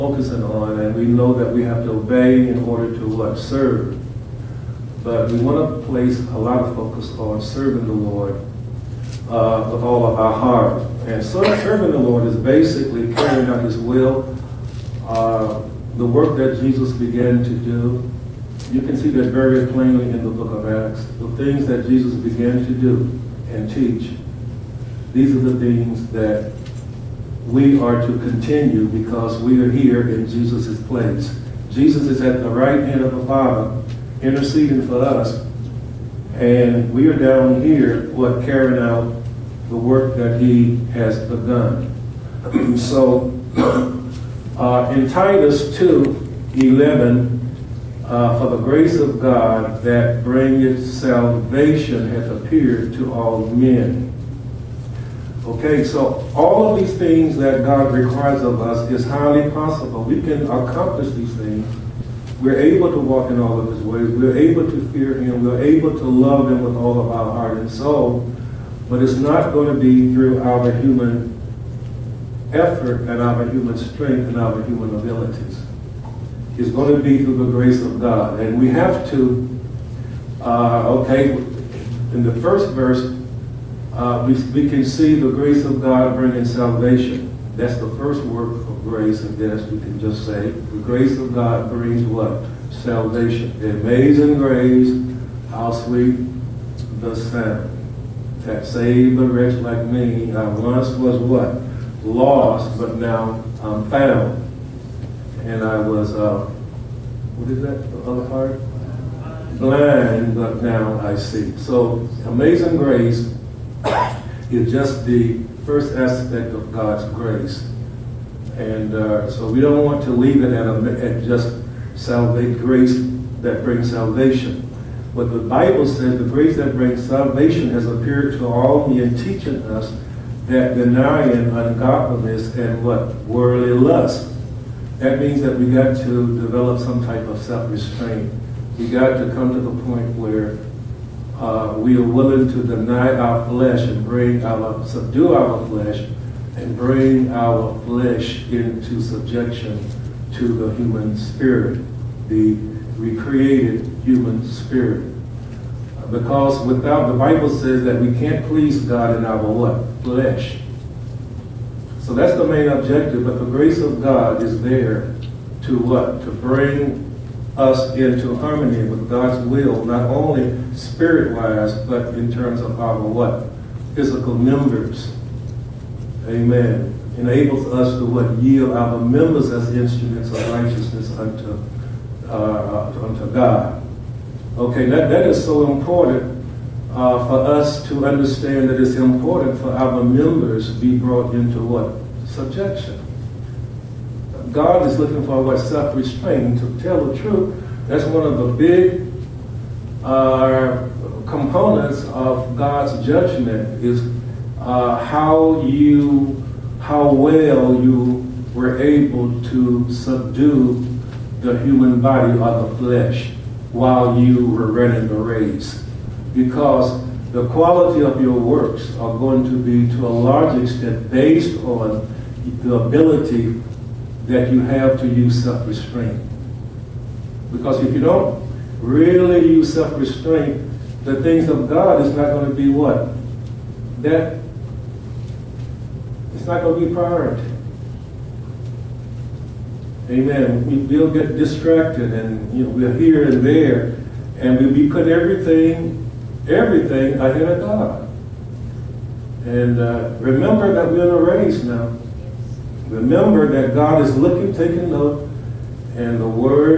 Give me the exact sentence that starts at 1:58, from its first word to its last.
And uh, so we don't want to leave it at, a, at just salvation grace that brings salvation.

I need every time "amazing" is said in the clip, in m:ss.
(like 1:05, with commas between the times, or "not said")
1:33, 1:52.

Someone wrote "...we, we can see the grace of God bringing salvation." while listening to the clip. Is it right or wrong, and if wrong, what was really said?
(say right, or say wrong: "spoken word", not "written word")
right.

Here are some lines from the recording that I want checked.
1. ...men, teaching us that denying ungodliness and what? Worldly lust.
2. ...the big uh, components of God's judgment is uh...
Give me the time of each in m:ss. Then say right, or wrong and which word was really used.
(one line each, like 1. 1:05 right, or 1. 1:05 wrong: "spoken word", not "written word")
1. 2:08 right
2. 3:18 right.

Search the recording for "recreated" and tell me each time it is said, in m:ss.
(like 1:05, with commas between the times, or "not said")
2:32.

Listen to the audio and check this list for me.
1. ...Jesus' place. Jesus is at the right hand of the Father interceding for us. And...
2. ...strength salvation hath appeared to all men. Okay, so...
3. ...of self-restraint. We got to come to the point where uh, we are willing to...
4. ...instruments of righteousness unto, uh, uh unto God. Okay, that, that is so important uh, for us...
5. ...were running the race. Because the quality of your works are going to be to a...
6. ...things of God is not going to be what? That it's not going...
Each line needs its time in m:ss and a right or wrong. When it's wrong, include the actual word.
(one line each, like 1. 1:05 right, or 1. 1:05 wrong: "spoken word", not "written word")
1. 0:30 right
2. 0:50 wrong: "bringeth", not "strength"
3. 2:17 right
4. 2:59 right
5. 3:34 right
6. 3:51 right.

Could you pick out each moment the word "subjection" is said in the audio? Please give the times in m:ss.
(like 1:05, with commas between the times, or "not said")
2:29, 3:12.